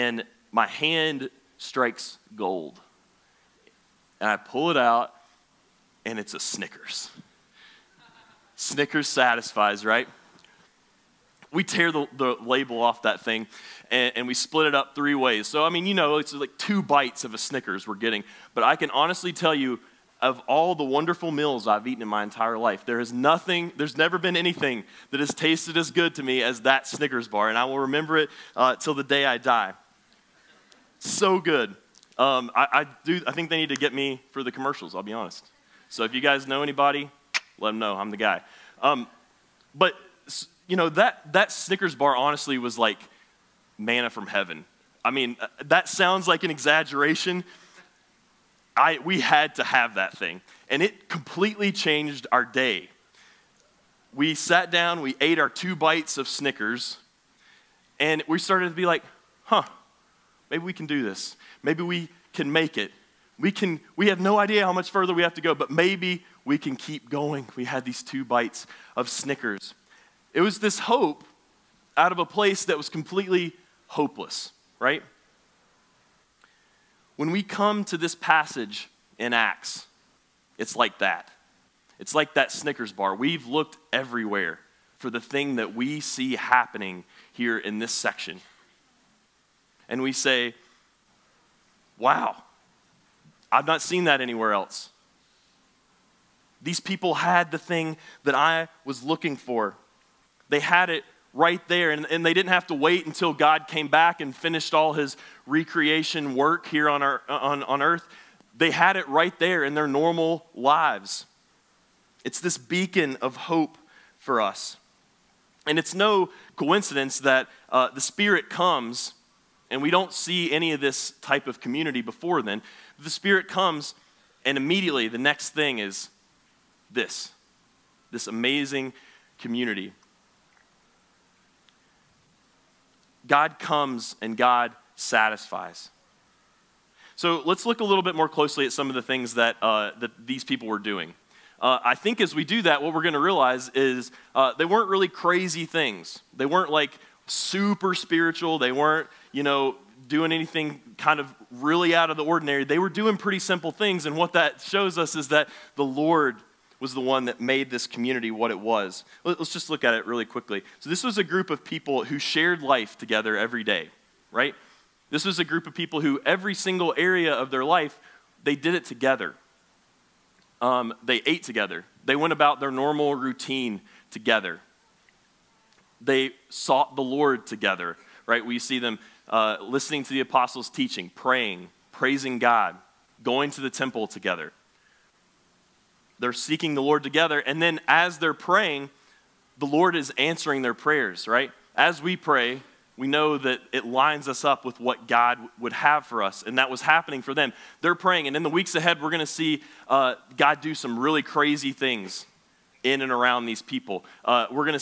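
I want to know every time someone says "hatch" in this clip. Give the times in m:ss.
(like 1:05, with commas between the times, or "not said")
not said.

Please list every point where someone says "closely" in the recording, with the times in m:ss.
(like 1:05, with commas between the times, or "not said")
2:18.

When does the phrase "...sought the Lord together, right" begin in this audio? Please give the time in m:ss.
2:56.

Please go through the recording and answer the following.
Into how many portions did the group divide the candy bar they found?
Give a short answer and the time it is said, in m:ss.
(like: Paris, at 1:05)
3, at 0:14.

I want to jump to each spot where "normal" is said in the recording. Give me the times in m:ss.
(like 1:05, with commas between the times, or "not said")
1:49, 2:52.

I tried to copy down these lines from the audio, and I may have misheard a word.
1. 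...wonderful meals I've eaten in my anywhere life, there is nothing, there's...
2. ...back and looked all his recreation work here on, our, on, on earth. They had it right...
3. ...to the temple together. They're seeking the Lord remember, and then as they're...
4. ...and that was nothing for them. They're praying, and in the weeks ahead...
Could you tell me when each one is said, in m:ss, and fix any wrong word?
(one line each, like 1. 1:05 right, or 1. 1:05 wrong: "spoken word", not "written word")
1. 0:20 wrong: "entire", not "anywhere"
2. 1:43 wrong: "finished", not "looked"
3. 3:03 wrong: "together", not "remember"
4. 3:16 wrong: "happening", not "nothing".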